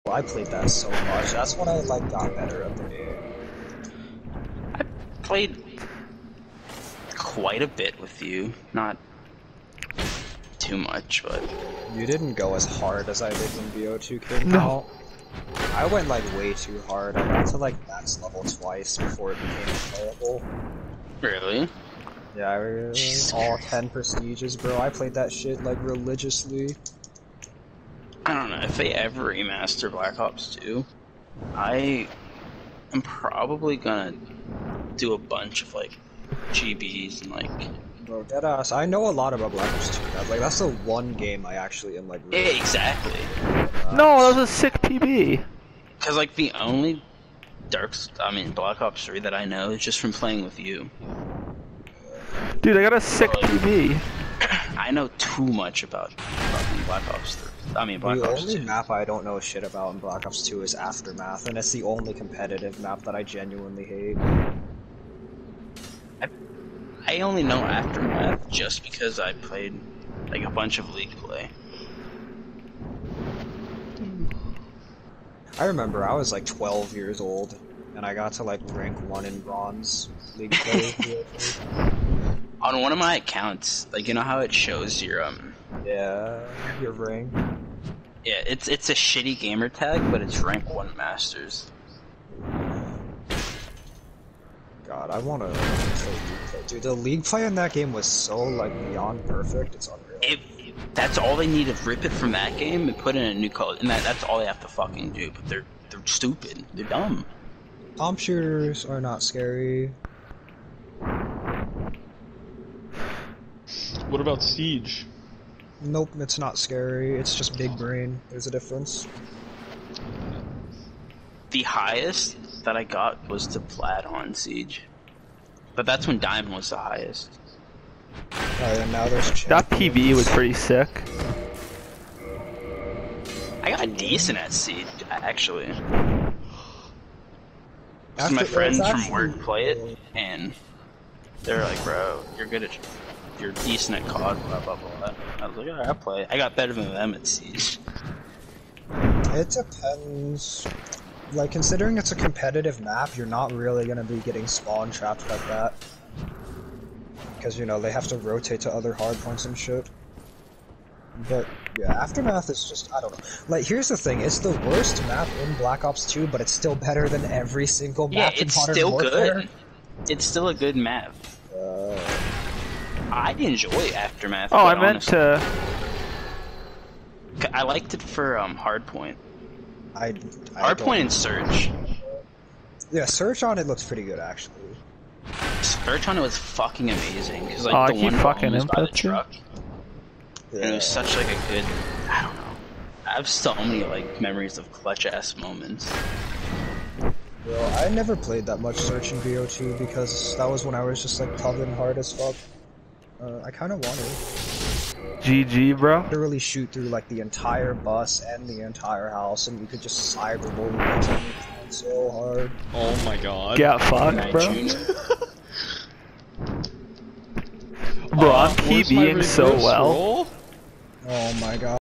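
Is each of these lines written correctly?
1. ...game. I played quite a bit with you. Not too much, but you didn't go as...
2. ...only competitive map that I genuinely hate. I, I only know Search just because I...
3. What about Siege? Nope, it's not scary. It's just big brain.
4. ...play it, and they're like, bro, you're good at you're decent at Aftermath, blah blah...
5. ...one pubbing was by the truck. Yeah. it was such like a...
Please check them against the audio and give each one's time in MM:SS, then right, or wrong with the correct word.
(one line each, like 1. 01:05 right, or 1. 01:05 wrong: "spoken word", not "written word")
1. 00:02 right
2. 01:01 wrong: "Aftermath", not "Search"
3. 01:54 right
4. 02:19 wrong: "COD", not "Aftermath"
5. 03:08 wrong: "fucking", not "pubbing".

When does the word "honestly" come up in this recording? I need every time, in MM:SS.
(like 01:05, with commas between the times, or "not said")
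02:55.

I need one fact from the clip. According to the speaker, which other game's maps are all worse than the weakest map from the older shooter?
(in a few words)
Modern Warfare.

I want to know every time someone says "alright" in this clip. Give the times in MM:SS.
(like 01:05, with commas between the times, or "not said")
02:08, 02:25.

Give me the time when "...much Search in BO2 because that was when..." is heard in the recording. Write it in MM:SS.
03:18.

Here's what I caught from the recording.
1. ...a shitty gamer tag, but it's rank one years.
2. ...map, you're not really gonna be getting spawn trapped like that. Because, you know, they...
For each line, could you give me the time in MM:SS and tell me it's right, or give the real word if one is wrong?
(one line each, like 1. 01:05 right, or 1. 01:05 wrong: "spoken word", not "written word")
1. 01:28 wrong: "masters", not "years"
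2. 02:32 right.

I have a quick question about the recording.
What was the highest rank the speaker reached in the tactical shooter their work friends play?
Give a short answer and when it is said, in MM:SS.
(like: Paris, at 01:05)
Plat, at 02:03.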